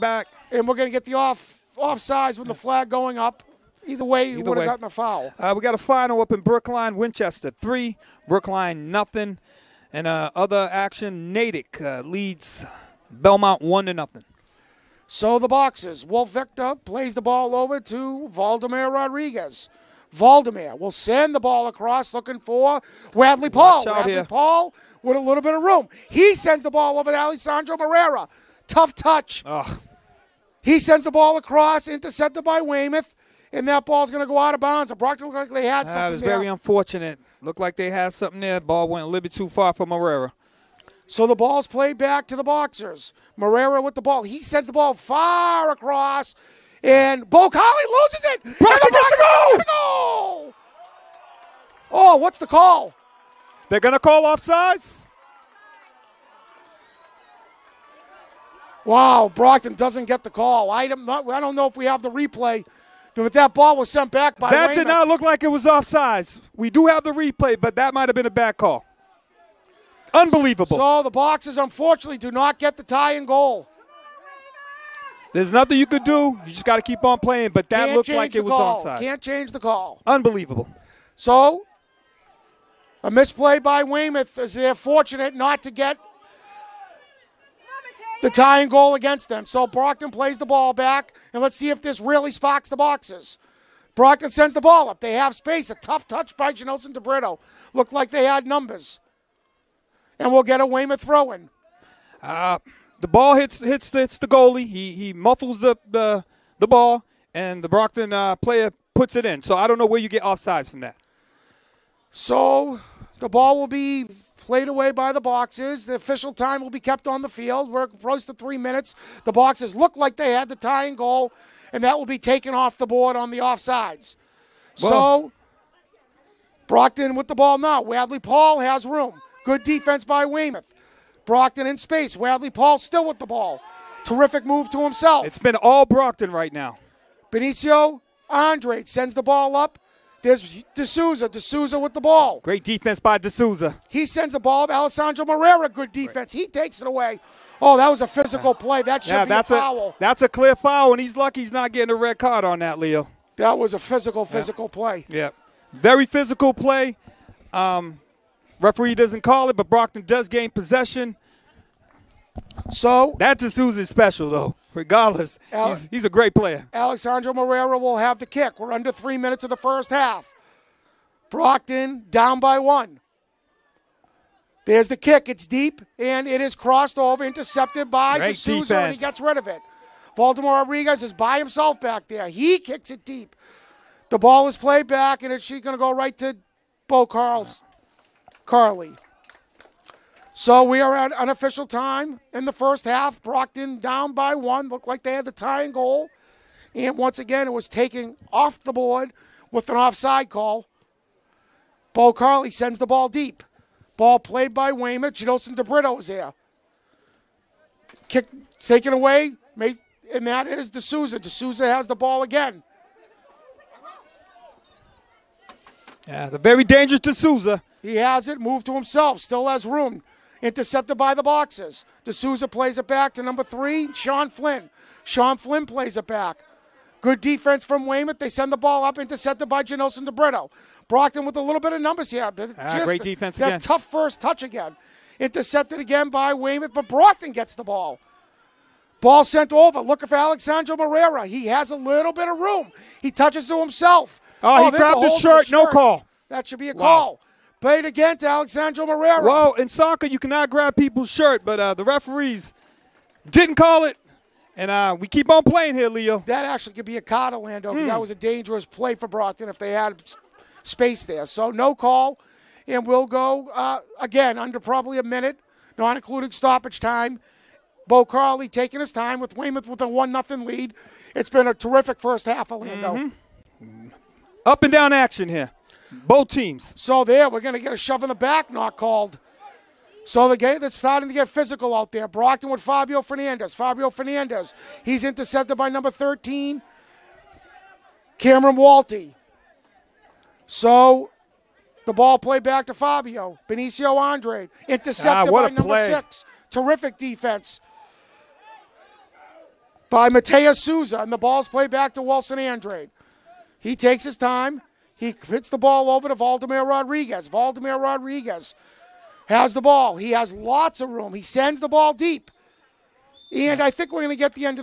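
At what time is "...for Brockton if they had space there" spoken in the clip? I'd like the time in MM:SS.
04:18.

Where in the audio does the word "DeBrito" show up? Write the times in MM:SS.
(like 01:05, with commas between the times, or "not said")
01:36, 03:25, 03:50.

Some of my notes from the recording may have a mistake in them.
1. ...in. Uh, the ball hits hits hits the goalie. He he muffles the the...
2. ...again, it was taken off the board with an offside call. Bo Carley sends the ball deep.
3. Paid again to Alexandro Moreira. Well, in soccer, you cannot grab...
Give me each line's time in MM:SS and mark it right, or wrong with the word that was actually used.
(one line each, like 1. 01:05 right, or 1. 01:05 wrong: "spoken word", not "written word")
1. 01:41 right
2. 03:17 right
3. 04:07 right.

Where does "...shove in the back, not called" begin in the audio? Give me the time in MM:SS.
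04:37.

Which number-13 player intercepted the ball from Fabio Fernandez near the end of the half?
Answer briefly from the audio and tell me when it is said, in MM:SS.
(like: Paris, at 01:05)
Cameron Walty, at 04:45.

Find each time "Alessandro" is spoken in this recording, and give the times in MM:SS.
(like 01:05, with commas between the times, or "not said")
00:27, 02:24.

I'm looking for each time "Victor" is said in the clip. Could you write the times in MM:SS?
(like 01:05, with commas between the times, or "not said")
00:16.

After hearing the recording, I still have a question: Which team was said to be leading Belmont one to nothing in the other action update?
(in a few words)
Natick.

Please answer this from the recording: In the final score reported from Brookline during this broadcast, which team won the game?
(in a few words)
Winchester.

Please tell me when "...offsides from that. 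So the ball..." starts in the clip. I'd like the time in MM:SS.
01:50.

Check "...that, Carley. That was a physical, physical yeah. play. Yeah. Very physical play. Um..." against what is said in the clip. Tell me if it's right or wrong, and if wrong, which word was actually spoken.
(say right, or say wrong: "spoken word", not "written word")
wrong: "Leo", not "Carley".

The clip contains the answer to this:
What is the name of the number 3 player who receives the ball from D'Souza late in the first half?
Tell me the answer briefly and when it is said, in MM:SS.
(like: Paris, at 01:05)
Sean Flynn, at 03:43.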